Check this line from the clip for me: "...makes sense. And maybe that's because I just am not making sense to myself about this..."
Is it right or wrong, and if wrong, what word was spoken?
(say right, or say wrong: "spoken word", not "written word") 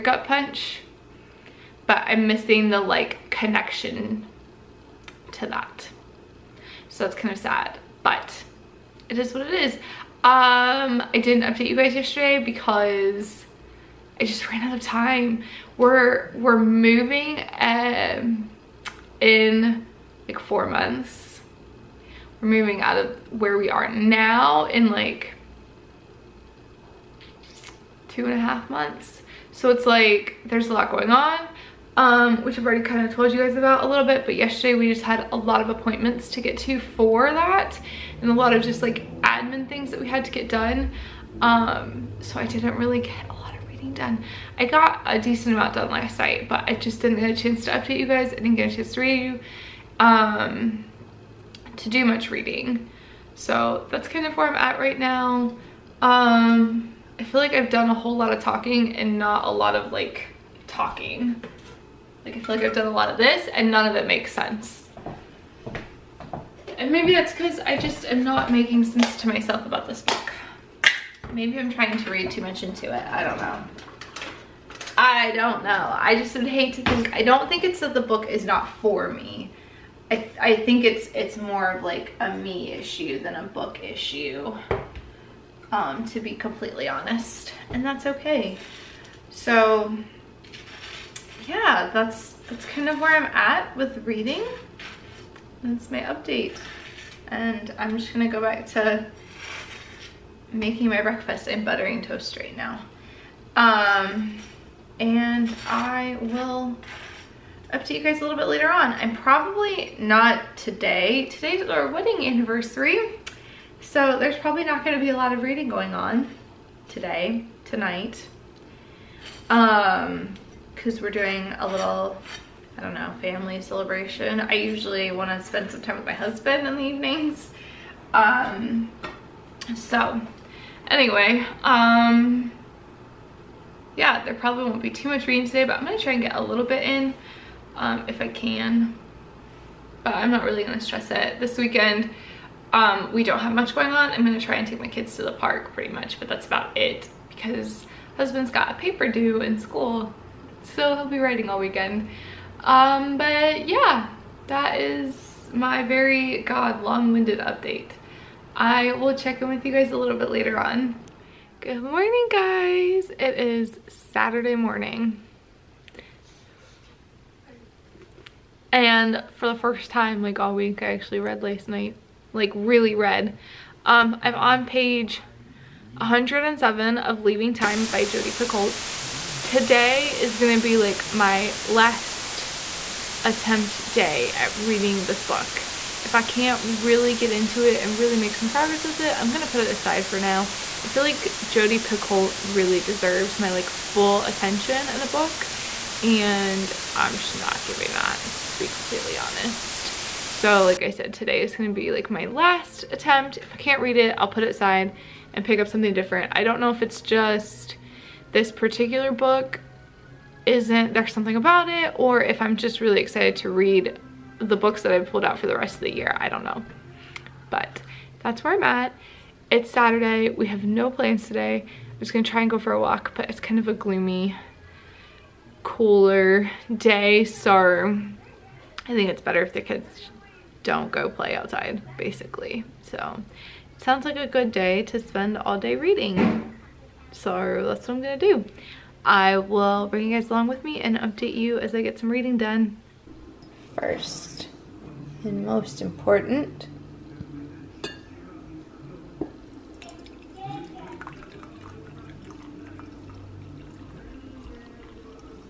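right.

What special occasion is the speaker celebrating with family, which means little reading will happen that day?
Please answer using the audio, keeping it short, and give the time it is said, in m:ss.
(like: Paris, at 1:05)
Wedding anniversary, at 1:51.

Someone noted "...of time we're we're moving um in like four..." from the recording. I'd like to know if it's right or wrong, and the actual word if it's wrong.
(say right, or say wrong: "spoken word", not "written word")
right.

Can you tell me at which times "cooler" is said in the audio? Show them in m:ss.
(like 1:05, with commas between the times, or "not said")
3:45.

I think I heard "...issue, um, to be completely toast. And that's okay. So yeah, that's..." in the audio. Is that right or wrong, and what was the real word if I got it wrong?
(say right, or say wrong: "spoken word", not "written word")
wrong: "honest", not "toast".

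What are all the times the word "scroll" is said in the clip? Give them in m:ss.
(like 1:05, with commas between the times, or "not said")
not said.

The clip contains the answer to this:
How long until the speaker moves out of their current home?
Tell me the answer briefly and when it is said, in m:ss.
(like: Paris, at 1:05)
2 and a half months, at 0:28.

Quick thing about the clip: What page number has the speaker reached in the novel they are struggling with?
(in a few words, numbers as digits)
107.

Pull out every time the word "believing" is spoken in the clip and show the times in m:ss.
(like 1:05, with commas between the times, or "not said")
not said.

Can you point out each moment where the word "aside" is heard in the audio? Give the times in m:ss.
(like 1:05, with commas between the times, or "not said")
3:09, 3:24.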